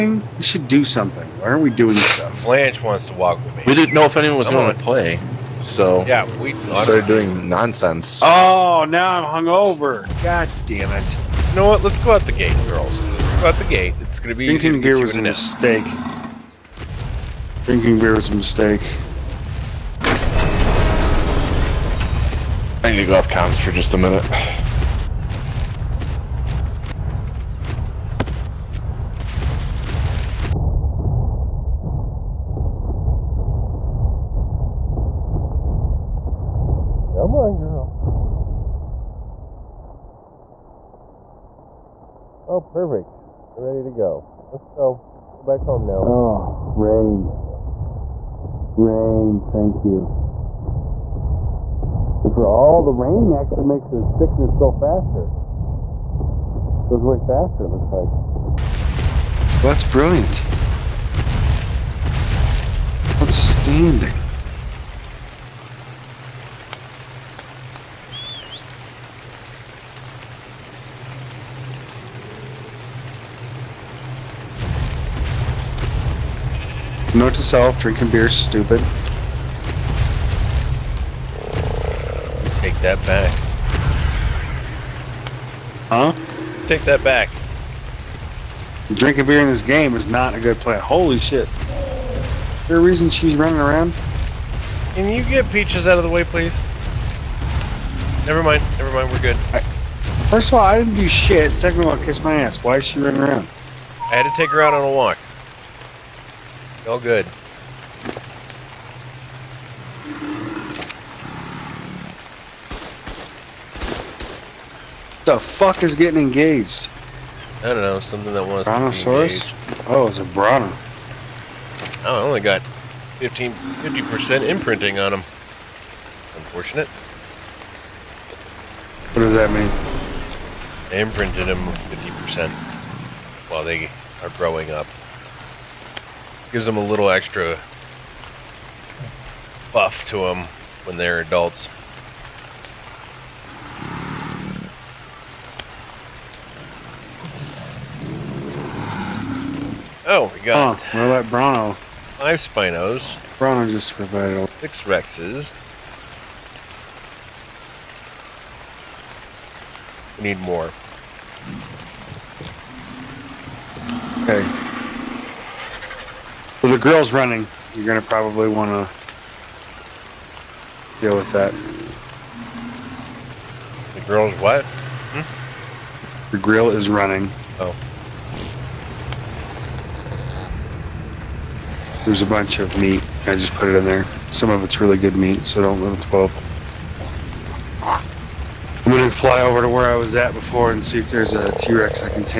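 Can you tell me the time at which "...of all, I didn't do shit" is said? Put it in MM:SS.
01:40.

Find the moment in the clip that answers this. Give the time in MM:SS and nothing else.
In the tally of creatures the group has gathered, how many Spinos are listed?
02:31.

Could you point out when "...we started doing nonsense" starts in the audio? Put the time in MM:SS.
00:06.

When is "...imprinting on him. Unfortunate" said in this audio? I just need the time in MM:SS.
02:04.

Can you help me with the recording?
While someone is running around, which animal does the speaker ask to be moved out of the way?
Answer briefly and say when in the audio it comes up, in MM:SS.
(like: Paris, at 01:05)
Peaches, at 01:35.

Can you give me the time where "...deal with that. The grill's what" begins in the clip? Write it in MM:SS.
02:50.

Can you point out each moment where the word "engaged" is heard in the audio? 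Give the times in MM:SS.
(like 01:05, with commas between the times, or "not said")
01:56.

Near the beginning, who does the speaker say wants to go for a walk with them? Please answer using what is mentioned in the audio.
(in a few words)
Blanche.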